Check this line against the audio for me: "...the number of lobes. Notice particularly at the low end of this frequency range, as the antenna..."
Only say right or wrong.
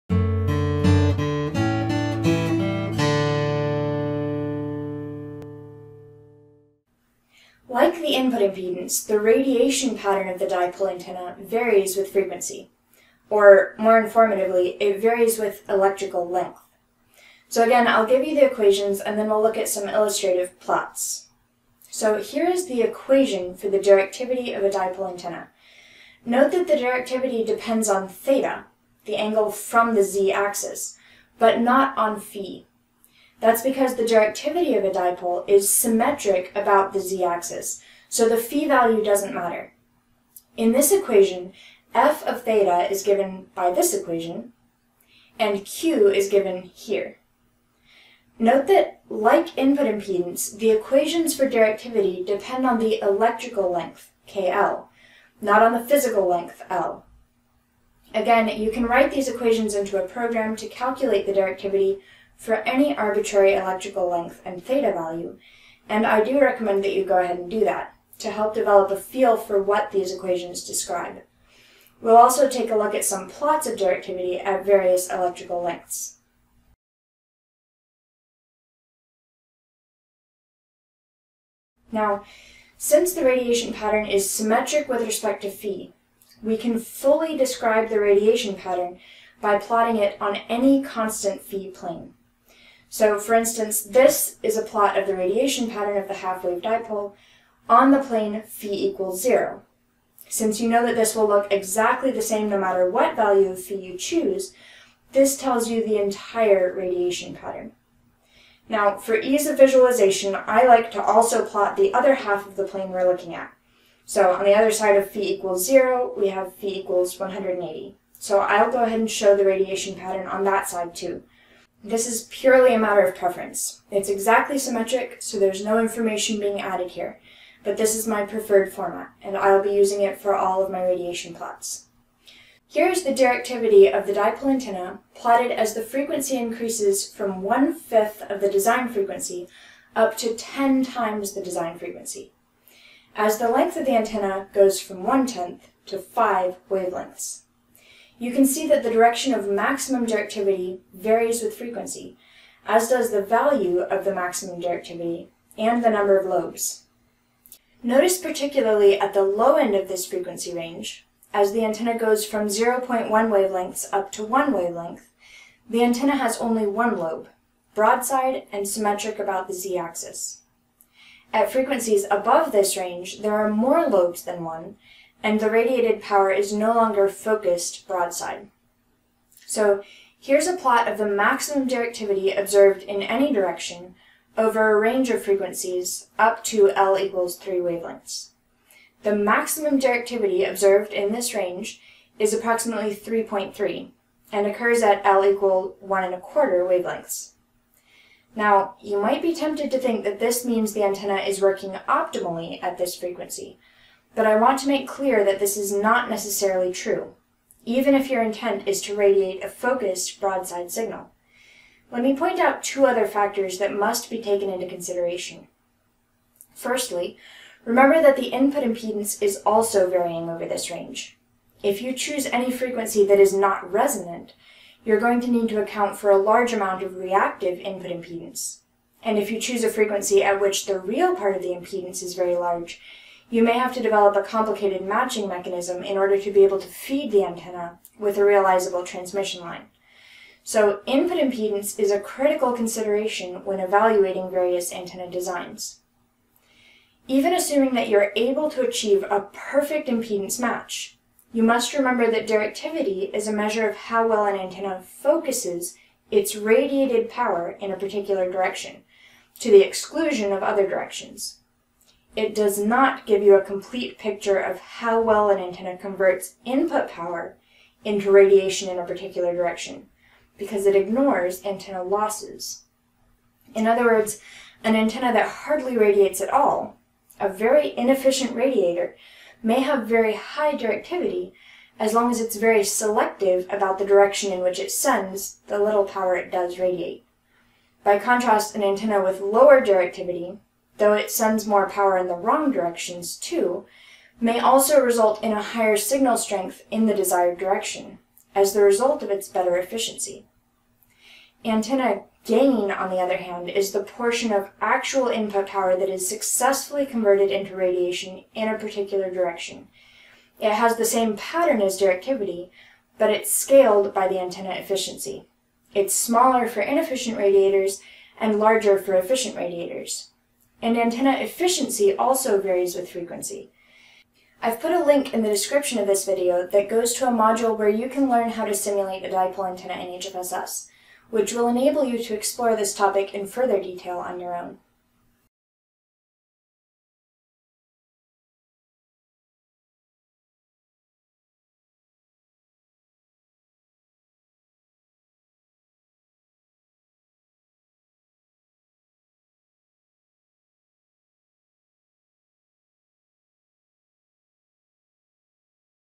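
right.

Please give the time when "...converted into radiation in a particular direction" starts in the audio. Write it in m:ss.
5:06.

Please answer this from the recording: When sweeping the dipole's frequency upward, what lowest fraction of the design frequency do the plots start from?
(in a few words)
1/5.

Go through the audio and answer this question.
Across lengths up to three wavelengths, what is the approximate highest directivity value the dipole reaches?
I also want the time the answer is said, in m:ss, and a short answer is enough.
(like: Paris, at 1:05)
3.3, at 3:12.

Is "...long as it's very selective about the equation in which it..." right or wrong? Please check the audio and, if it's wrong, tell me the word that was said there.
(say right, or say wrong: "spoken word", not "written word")
wrong: "direction", not "equation".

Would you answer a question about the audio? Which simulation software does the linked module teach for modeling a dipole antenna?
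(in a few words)
HFSS.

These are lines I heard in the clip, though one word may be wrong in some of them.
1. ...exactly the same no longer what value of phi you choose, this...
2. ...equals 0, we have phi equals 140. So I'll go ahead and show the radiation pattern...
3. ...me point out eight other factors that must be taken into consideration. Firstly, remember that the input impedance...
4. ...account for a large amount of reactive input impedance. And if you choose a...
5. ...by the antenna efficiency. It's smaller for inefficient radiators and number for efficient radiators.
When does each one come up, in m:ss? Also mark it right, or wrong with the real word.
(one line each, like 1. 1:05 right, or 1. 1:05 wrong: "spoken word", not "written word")
1. 1:41 wrong: "matter", not "longer"
2. 1:55 wrong: "180", not "140"
3. 3:32 wrong: "two", not "eight"
4. 3:45 right
5. 5:13 wrong: "larger", not "number".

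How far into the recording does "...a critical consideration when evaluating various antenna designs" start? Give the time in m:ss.
4:01.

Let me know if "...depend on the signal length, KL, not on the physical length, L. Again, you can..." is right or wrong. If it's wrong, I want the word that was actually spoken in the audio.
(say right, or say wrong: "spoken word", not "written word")
wrong: "electrical", not "signal".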